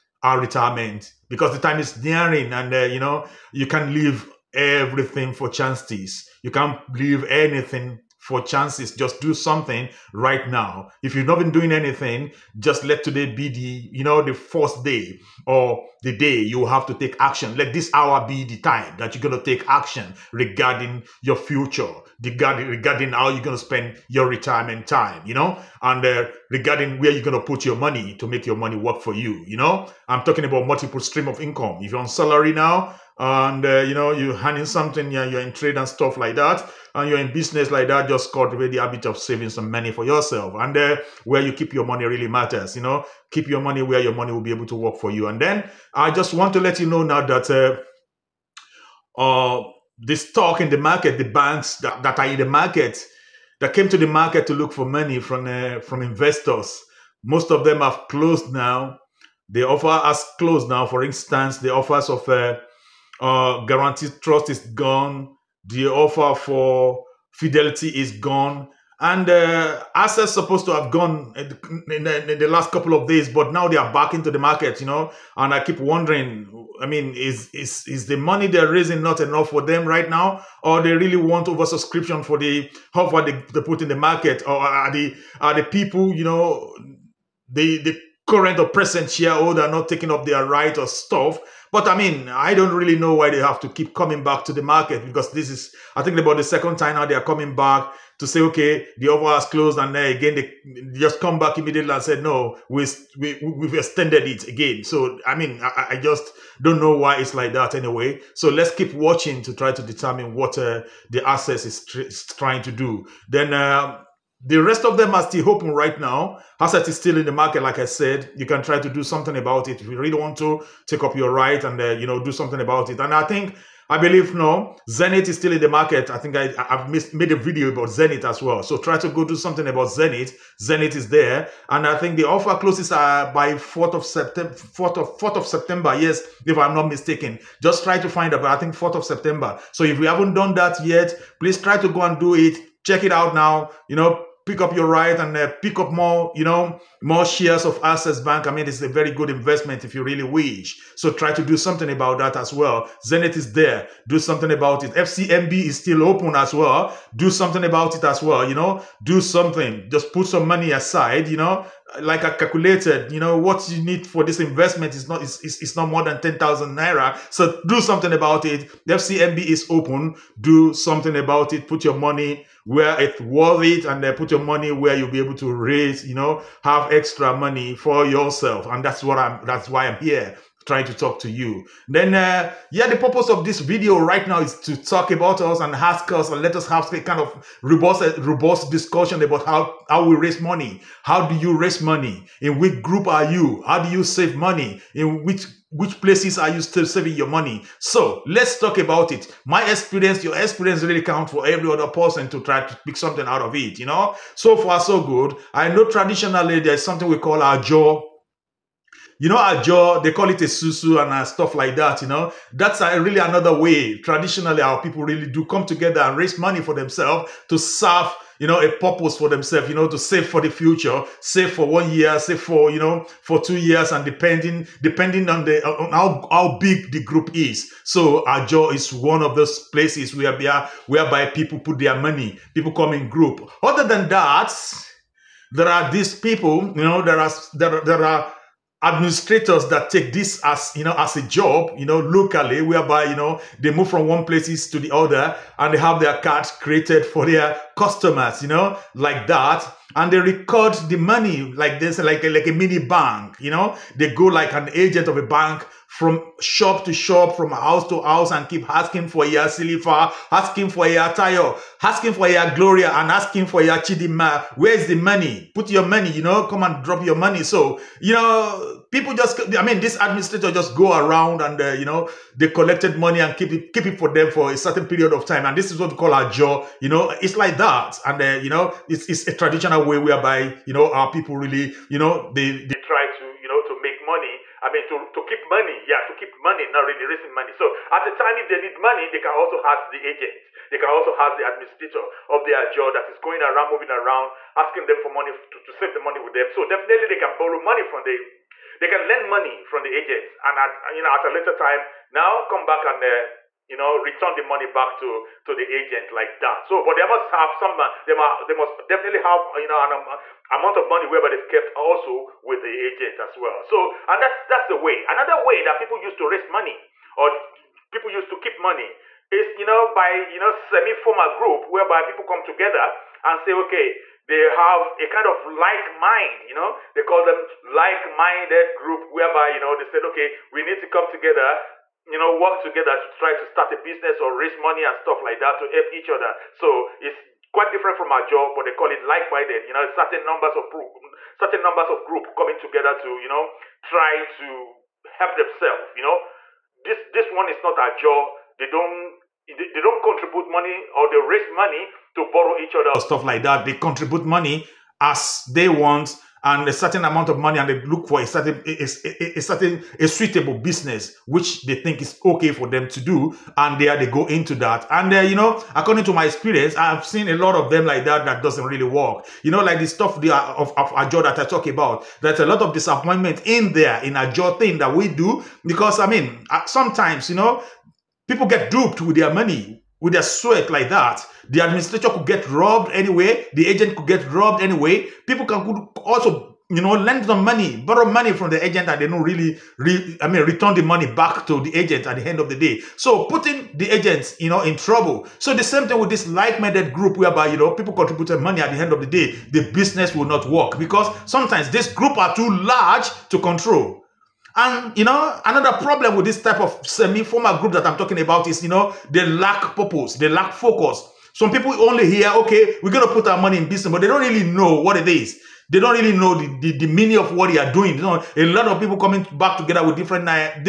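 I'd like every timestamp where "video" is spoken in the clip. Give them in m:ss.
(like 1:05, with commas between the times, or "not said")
2:07, 3:03.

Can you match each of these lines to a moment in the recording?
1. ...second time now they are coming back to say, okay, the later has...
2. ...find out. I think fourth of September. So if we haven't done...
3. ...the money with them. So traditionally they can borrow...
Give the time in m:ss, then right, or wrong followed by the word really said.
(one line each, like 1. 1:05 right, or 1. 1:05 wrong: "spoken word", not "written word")
1. 1:36 wrong: "offer", not "later"
2. 2:18 right
3. 4:55 wrong: "definitely", not "traditionally".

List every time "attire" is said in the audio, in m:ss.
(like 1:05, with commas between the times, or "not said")
4:21.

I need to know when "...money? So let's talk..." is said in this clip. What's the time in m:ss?
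3:17.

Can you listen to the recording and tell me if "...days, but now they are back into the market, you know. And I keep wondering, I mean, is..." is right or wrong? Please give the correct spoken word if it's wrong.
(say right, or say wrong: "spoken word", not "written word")
right.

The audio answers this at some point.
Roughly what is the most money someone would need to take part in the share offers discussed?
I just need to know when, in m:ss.
2:46.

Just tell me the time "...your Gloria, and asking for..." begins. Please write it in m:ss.
4:22.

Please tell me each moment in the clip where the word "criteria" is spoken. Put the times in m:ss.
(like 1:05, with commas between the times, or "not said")
not said.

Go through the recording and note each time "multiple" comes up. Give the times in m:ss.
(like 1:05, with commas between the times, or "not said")
0:30.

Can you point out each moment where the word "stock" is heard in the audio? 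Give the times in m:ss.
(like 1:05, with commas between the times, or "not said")
0:50.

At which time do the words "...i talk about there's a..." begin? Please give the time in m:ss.
6:11.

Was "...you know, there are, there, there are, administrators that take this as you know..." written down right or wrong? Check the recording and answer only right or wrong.
right.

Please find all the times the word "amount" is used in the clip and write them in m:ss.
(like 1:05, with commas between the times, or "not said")
5:10, 5:57.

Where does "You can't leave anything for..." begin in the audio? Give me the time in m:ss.
0:06.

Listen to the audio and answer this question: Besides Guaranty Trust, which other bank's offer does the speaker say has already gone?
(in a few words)
Fidelity.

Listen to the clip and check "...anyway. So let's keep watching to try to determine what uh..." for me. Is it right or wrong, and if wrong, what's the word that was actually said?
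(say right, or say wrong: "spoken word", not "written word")
right.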